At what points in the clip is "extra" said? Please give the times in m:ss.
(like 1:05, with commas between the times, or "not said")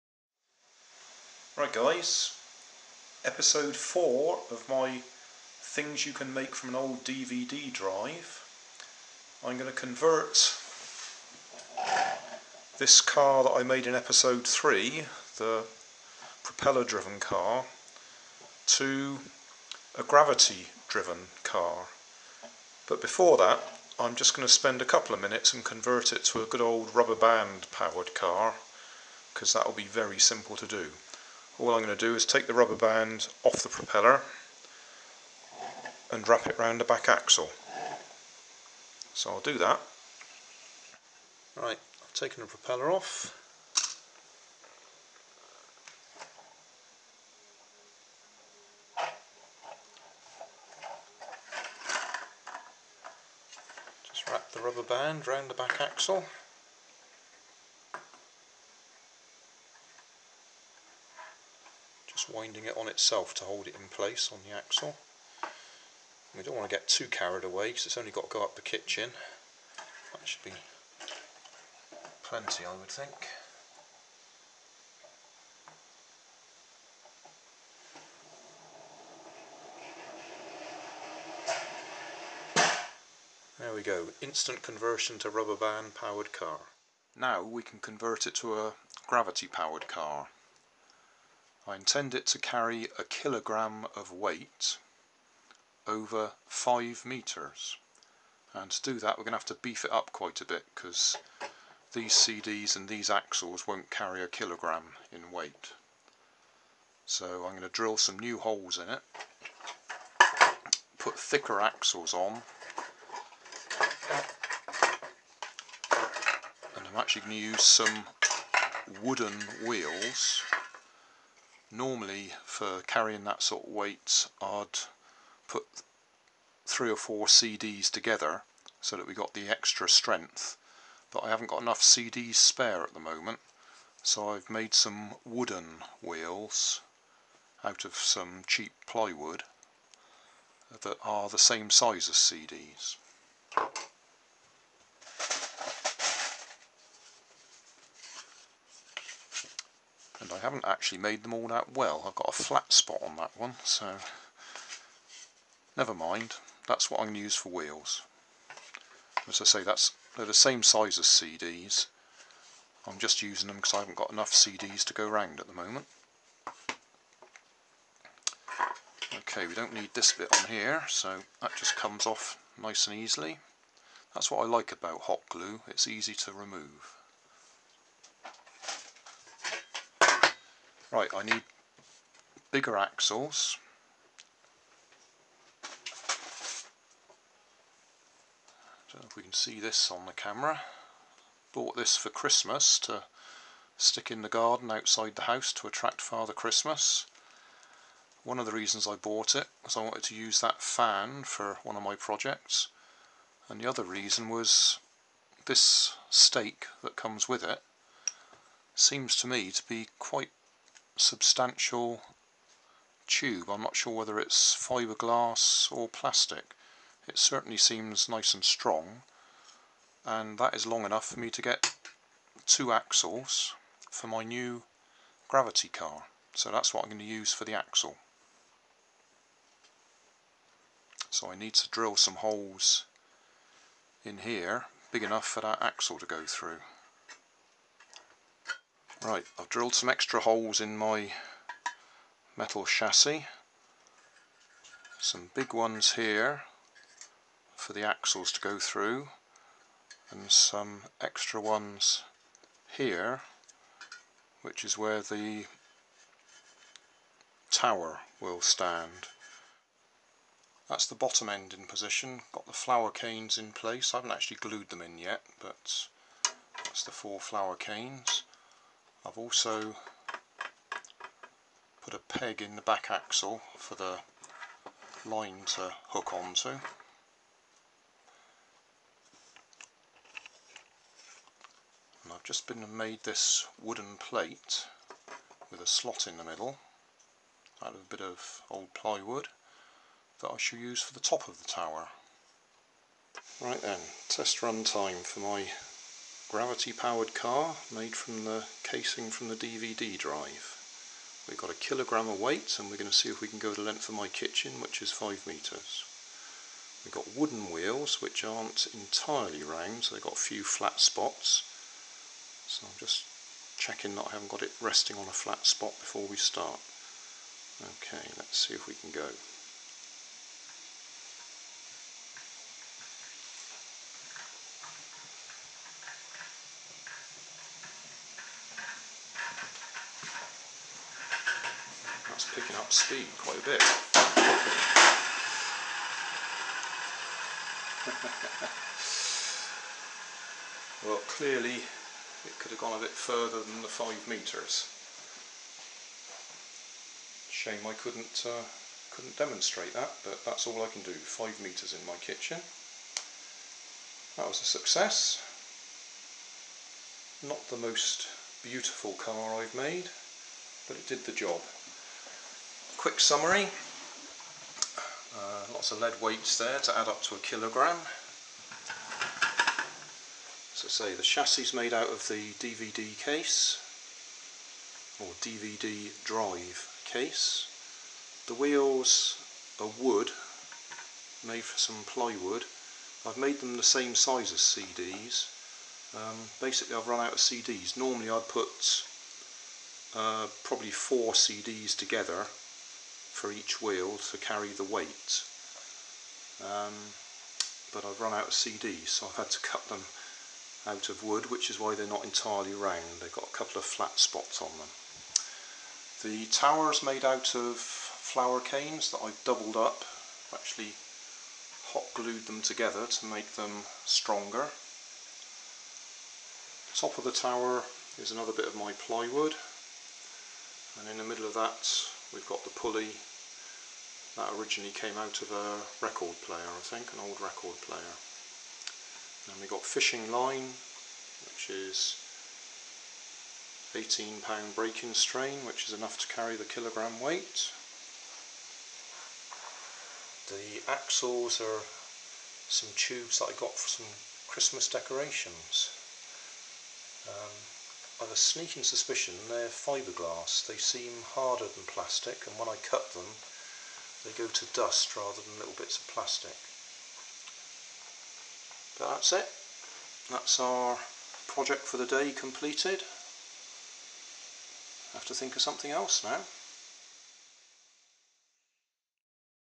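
2:09, 3:59, 4:11.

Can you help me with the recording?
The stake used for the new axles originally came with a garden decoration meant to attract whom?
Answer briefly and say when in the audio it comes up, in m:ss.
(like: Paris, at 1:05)
Father Christmas, at 3:16.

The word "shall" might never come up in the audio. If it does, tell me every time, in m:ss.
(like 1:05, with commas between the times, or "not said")
4:50.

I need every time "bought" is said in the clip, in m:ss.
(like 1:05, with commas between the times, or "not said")
3:11, 3:18.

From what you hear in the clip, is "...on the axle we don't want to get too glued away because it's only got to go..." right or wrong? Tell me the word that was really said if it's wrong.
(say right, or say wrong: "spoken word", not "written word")
wrong: "carried", not "glued".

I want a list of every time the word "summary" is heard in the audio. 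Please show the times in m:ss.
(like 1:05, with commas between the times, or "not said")
6:02.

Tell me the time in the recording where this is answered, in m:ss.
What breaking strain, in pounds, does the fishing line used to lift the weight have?
7:13.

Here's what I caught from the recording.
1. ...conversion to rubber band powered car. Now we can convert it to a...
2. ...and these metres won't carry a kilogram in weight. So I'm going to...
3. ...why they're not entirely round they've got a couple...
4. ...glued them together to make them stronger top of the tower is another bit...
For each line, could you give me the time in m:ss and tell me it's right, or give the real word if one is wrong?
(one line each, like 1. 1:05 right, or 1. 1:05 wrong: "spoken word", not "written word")
1. 1:24 right
2. 1:42 wrong: "axles", not "metres"
3. 6:41 right
4. 6:51 right.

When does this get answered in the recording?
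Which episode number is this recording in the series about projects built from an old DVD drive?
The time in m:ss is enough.
0:03.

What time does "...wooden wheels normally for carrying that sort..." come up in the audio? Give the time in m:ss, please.
1:59.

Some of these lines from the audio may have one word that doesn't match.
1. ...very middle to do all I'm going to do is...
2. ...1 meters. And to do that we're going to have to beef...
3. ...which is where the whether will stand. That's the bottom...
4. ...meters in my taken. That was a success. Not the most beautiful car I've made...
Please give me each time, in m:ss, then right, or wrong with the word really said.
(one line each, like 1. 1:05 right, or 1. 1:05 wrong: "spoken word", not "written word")
1. 0:29 wrong: "simple", not "middle"
2. 1:36 wrong: "5", not "1"
3. 4:14 wrong: "tower", not "whether"
4. 5:51 wrong: "kitchen", not "taken".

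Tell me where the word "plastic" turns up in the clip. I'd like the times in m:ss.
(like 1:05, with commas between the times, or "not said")
3:35, 7:31, 7:35.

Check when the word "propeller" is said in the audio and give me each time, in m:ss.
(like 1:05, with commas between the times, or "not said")
0:16, 0:33, 0:42.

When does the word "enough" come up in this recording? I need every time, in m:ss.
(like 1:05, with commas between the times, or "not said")
2:11, 2:44, 3:40, 3:55, 7:15.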